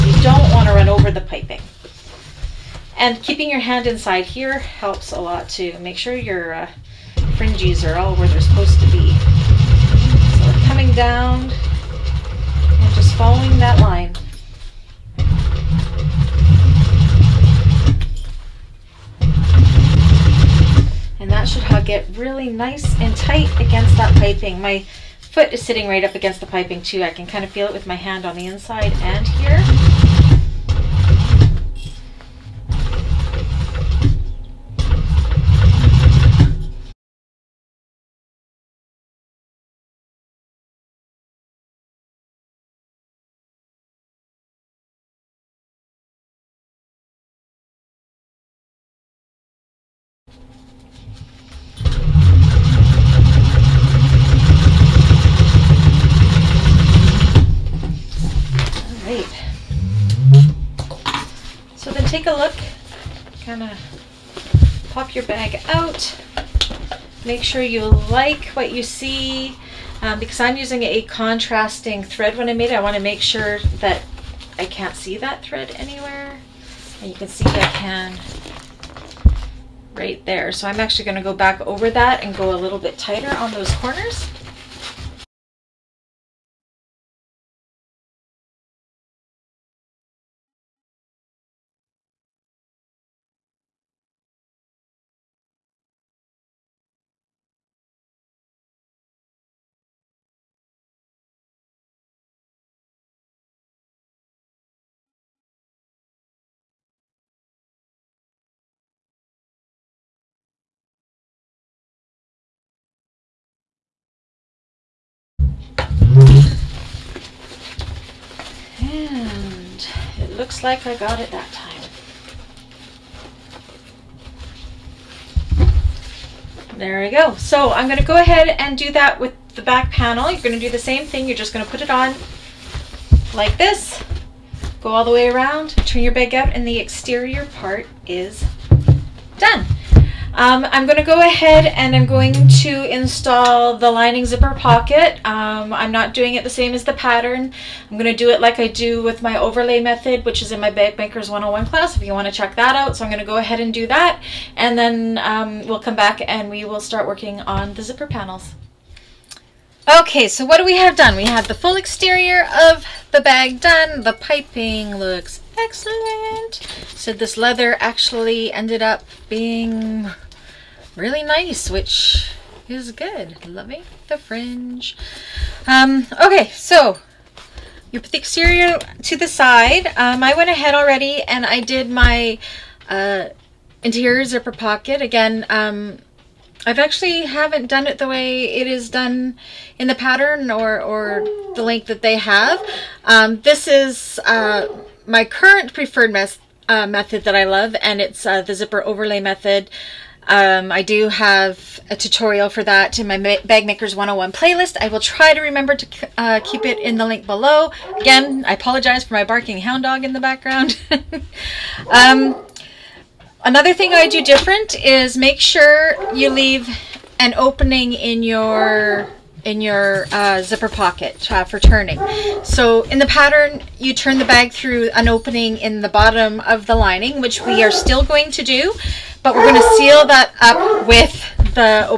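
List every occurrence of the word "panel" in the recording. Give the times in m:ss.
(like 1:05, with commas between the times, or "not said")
2:09, 2:38.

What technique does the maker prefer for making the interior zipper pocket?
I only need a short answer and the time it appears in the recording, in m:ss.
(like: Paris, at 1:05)
zipper overlay method, at 3:18.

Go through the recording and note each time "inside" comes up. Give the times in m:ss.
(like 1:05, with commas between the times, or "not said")
0:03, 0:28.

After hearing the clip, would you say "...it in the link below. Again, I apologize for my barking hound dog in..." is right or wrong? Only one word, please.
right.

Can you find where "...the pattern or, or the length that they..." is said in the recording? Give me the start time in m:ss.
3:09.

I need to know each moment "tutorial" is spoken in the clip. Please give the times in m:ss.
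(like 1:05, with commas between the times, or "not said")
3:21.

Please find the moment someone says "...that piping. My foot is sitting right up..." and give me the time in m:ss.
0:23.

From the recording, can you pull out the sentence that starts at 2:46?
So this leather actually ended up being really nice, which is good.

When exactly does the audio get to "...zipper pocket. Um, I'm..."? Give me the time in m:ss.
2:24.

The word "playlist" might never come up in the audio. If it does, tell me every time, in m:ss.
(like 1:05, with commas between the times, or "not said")
3:24.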